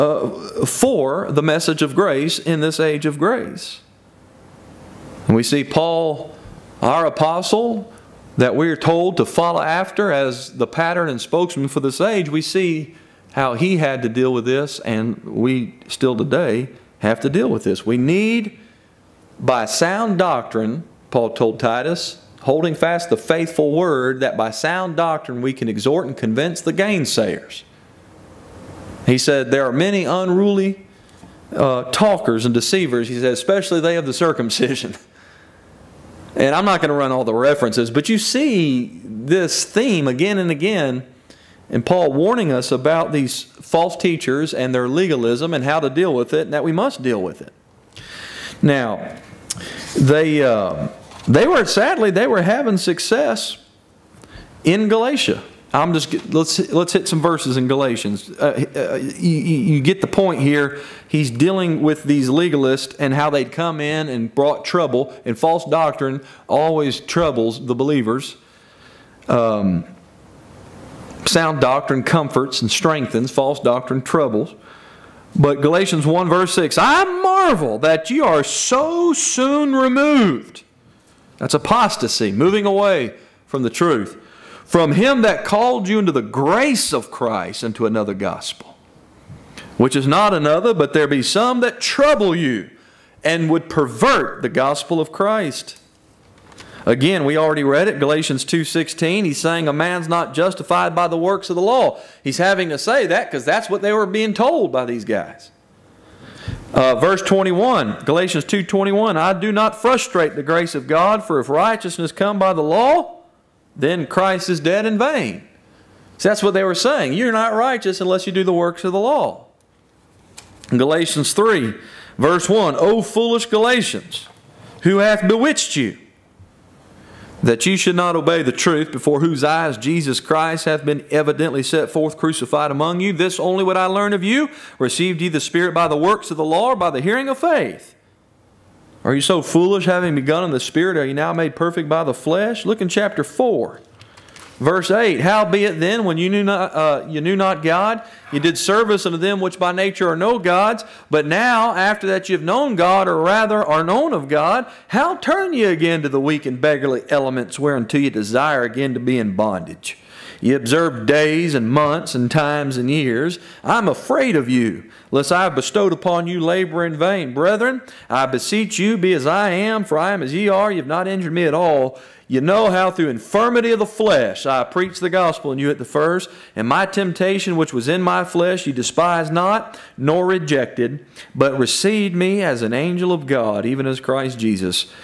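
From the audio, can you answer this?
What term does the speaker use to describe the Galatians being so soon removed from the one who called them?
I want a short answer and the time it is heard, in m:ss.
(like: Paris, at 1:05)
Apostasy, at 1:21.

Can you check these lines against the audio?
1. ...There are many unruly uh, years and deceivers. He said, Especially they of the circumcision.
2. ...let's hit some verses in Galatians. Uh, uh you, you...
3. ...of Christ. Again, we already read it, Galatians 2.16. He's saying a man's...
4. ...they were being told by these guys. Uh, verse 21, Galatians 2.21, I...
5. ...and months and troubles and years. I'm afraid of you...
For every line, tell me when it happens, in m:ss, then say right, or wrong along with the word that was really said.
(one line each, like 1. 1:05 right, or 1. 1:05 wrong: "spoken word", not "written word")
1. 0:29 wrong: "talkers", not "years"
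2. 0:56 right
3. 1:34 right
4. 1:43 right
5. 2:41 wrong: "times", not "troubles".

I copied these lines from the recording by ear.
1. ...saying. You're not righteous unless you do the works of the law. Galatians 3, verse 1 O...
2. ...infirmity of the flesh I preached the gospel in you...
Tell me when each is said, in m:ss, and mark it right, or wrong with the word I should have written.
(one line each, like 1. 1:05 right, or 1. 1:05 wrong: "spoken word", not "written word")
1. 1:56 right
2. 2:53 right.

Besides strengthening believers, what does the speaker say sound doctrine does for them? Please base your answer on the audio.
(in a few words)
Comforts.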